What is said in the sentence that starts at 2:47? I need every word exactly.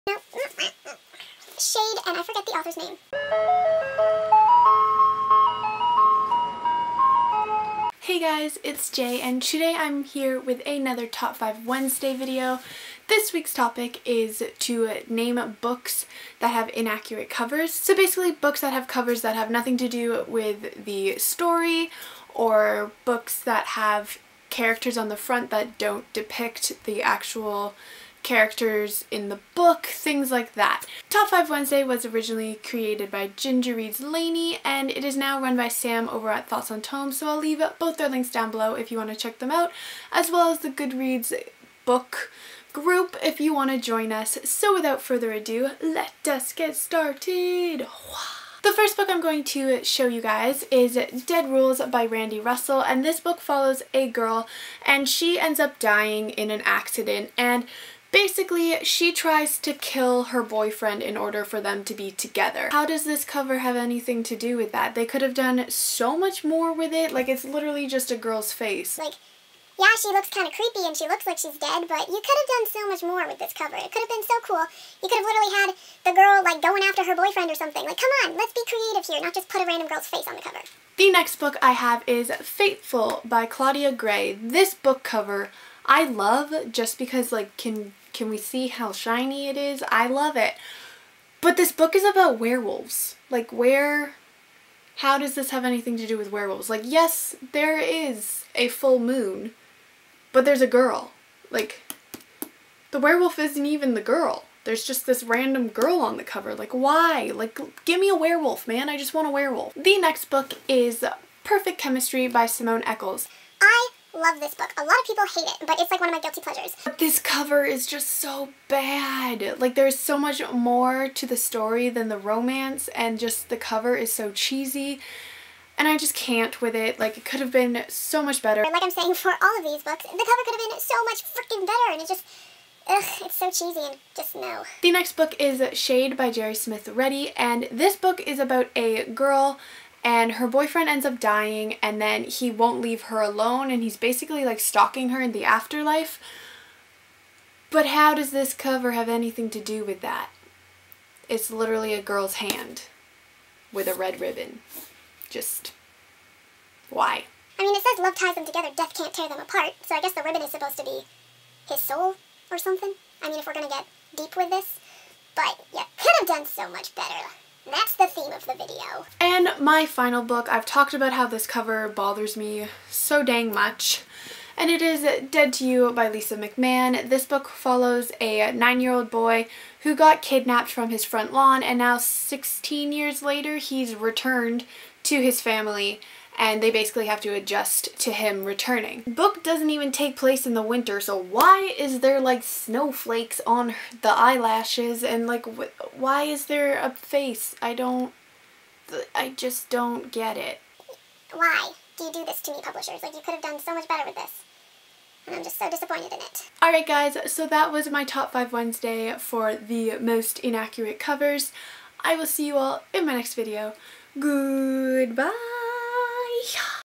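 That's the theme of the video.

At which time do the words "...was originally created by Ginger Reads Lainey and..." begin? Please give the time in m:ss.
0:31.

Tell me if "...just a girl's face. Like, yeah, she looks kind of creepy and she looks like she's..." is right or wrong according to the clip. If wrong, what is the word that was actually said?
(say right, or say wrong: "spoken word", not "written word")
right.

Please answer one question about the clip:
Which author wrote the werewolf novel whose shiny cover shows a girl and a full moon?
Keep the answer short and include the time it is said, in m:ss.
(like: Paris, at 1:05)
Claudia Gray, at 1:23.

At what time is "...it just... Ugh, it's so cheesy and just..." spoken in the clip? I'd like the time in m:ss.
2:12.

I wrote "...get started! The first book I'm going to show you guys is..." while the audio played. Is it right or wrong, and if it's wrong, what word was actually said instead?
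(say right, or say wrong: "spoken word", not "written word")
right.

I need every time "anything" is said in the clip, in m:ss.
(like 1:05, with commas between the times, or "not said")
1:03, 1:35, 2:29.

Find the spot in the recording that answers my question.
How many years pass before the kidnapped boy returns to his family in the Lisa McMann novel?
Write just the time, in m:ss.
3:01.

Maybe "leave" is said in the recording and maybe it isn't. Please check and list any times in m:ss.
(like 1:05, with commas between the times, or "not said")
0:37, 2:22.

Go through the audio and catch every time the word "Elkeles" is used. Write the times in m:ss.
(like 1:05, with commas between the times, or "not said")
1:52.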